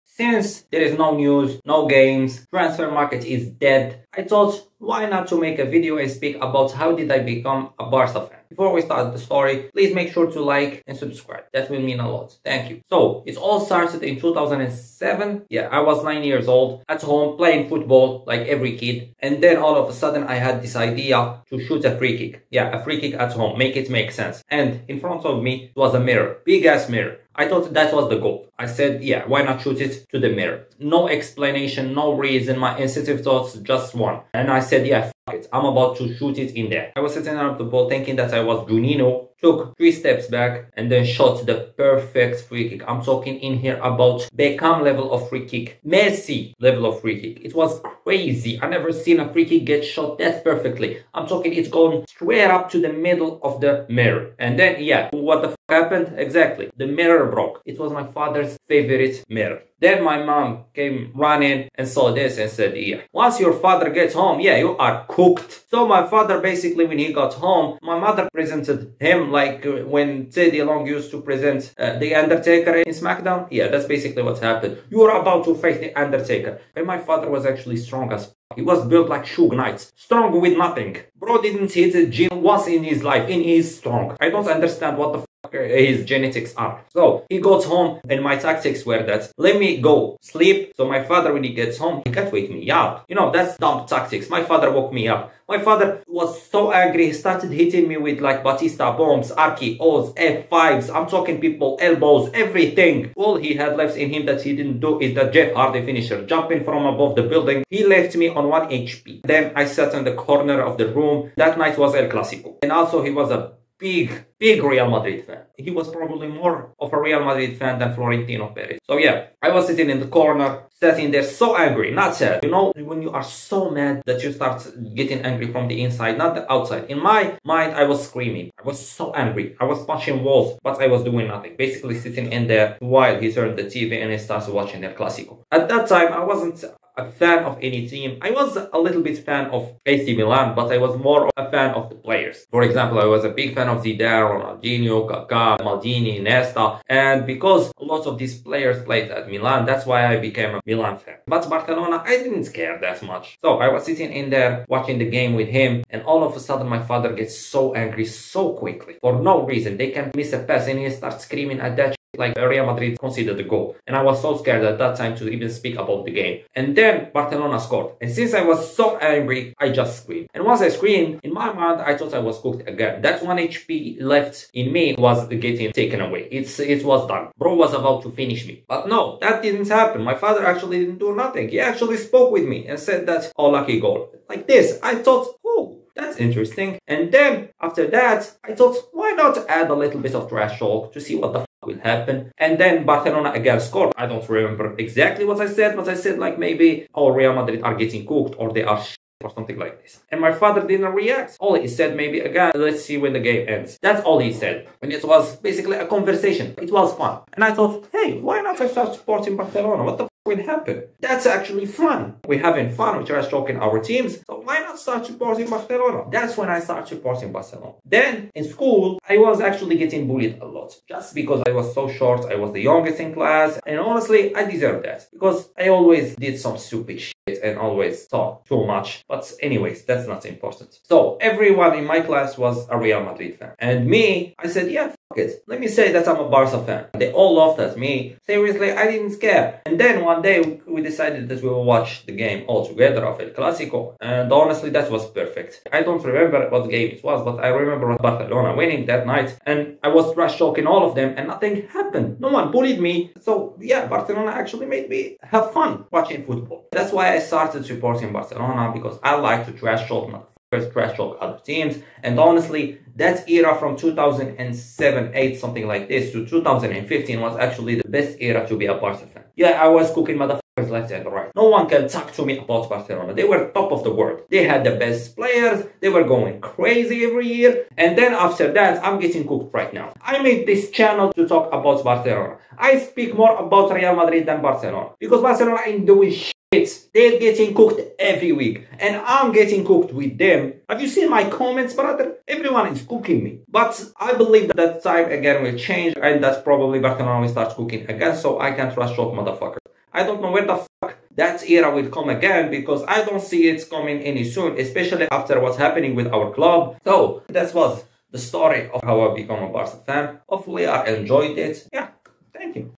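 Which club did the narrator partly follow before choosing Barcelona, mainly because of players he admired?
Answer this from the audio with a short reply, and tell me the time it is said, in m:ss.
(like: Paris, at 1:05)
AC Milan, at 2:19.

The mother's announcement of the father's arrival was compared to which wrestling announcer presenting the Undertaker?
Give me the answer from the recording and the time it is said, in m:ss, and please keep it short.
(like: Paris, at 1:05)
Teddy Long, at 1:10.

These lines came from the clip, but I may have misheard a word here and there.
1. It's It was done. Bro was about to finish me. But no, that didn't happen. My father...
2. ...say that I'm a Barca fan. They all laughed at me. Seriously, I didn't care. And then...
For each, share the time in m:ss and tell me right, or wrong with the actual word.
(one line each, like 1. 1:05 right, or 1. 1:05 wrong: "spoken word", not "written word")
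1. 2:56 right
2. 3:55 right.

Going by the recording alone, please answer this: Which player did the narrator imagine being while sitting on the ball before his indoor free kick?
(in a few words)
Juninho.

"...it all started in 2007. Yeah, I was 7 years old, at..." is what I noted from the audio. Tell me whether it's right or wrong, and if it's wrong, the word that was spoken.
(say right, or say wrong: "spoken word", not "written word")
wrong: "9", not "7".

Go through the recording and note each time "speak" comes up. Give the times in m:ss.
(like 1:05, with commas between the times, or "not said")
0:06, 2:45, 4:42.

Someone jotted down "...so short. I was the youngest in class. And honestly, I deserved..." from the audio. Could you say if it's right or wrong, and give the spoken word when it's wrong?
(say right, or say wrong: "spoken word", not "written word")
right.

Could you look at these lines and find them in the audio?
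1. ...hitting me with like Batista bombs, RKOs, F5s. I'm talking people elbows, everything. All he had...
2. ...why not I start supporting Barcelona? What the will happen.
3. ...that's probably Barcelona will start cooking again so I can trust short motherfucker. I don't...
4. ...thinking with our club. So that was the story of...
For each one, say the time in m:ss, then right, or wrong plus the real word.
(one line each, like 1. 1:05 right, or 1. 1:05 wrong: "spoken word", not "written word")
1. 1:37 right
2. 3:28 right
3. 4:56 right
4. 5:05 wrong: "happening", not "thinking".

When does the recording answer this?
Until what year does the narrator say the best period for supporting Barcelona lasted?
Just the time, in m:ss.
4:26.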